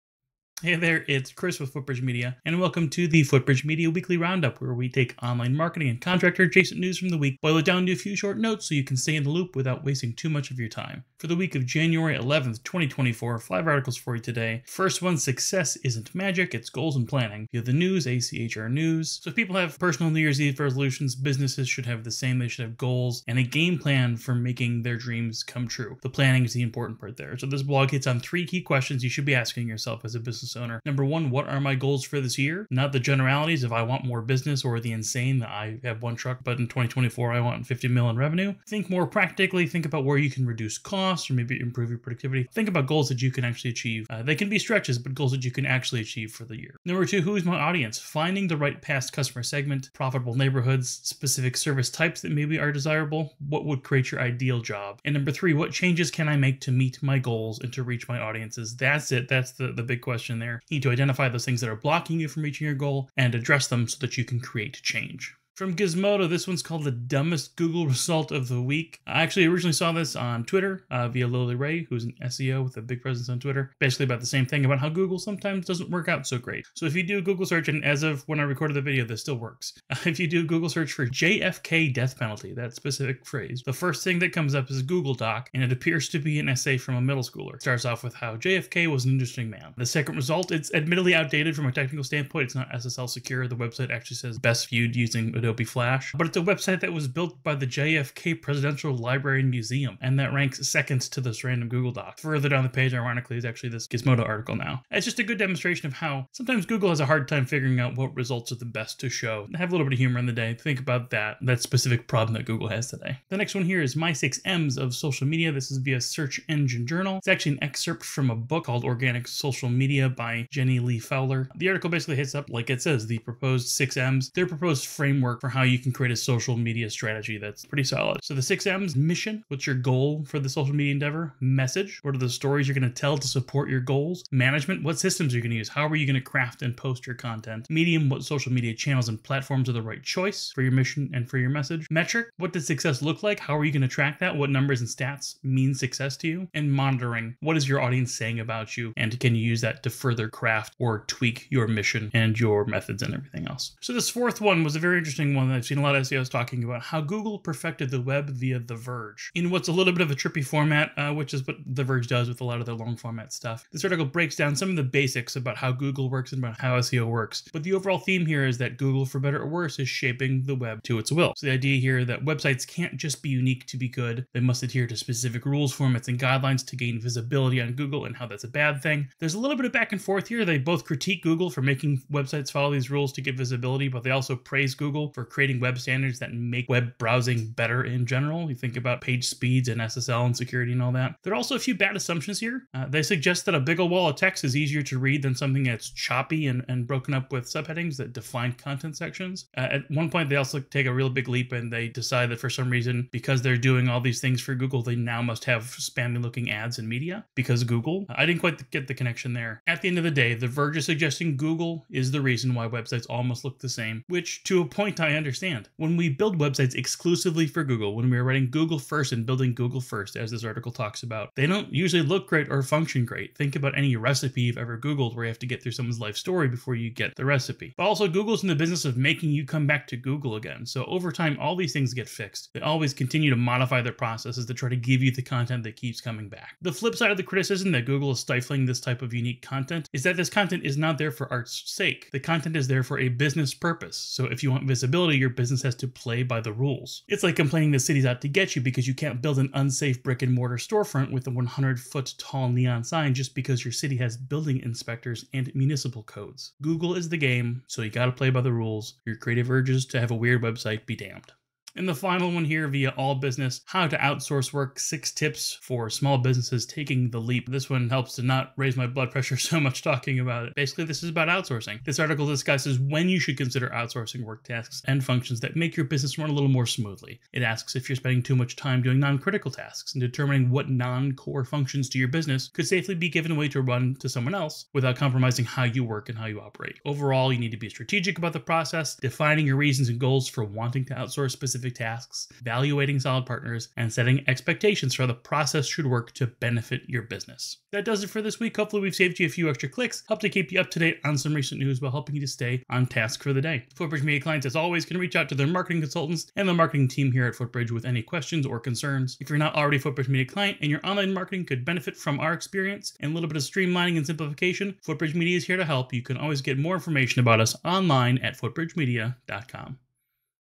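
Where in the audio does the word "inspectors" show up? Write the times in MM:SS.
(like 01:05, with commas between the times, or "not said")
04:14.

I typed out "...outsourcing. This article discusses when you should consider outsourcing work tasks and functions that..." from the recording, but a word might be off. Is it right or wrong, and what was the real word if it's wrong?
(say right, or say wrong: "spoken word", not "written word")
right.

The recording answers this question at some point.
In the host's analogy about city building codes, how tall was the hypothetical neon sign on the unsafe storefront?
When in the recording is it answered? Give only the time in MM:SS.
04:11.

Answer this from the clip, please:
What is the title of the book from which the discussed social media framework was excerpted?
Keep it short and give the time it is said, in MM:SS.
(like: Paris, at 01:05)
Organic Social Media, at 01:58.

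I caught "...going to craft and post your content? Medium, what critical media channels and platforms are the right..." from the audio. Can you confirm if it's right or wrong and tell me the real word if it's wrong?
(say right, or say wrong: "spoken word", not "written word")
wrong: "social", not "critical".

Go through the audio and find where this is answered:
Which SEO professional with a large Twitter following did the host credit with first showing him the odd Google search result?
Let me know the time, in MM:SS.
01:11.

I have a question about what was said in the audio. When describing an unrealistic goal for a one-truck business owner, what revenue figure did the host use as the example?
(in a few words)
50 mil.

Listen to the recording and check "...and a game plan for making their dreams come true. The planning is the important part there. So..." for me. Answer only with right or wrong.
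right.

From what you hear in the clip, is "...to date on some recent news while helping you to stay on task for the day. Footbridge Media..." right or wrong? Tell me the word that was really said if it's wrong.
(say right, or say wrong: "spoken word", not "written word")
right.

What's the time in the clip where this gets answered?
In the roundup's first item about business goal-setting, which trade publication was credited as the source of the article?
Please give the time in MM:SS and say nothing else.
00:18.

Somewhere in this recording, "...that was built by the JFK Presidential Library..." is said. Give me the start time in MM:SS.
01:36.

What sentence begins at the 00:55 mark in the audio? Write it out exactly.
And number three, what changes can I make to meet my goals and to reach my audiences?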